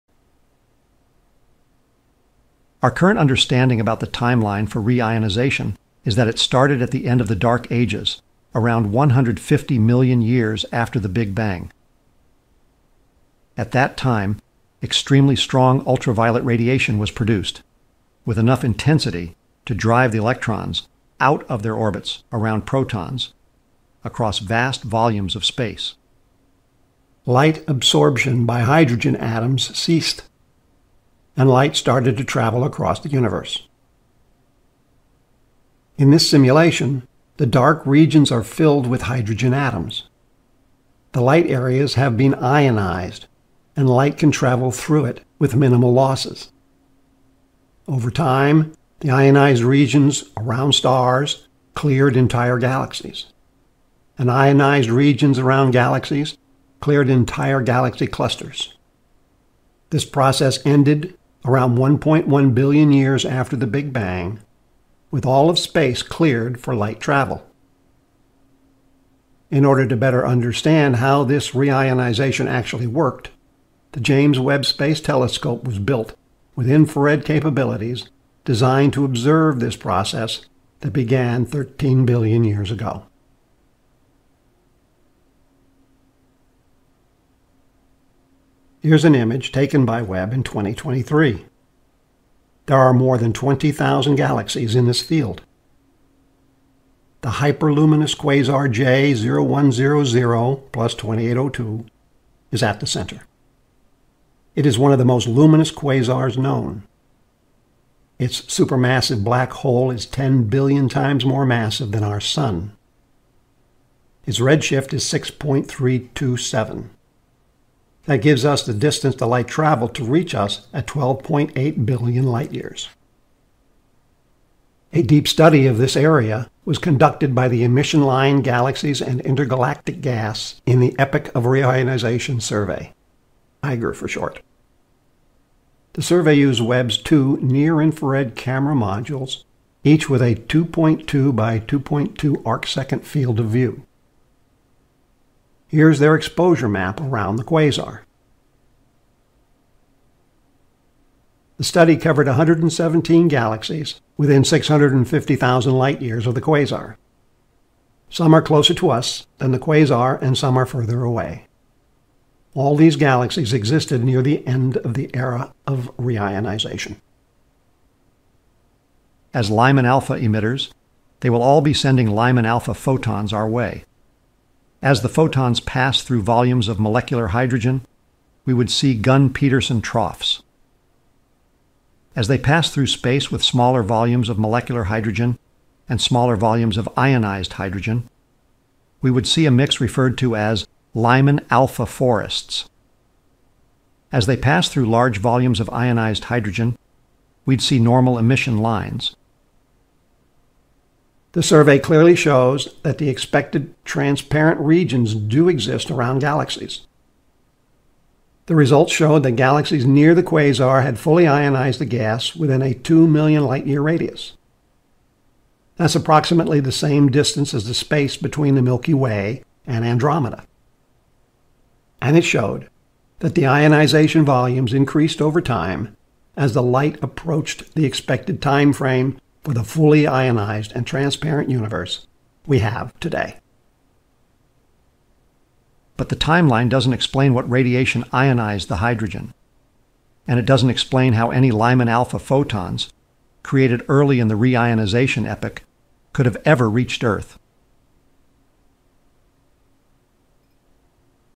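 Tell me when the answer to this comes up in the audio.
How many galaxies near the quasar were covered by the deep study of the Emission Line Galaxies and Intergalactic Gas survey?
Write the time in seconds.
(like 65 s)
152 s.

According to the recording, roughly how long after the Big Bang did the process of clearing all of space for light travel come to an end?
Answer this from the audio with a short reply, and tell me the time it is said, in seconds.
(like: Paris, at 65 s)
1.1 billion years, at 61 s.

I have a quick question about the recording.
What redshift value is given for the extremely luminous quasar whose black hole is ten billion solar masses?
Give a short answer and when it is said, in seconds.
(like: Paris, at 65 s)
6.327, at 115 s.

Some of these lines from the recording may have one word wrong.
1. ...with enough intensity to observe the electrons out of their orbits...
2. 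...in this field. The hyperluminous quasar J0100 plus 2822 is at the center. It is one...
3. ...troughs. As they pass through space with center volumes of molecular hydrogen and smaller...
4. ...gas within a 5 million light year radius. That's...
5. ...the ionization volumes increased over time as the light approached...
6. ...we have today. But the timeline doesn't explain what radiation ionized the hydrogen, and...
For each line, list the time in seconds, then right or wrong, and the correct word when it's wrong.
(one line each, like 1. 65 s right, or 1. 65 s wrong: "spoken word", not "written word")
1. 18 s wrong: "drive", not "observe"
2. 94 s wrong: "2802", not "2822"
3. 179 s wrong: "smaller", not "center"
4. 211 s wrong: "2", not "5"
5. 223 s right
6. 232 s right.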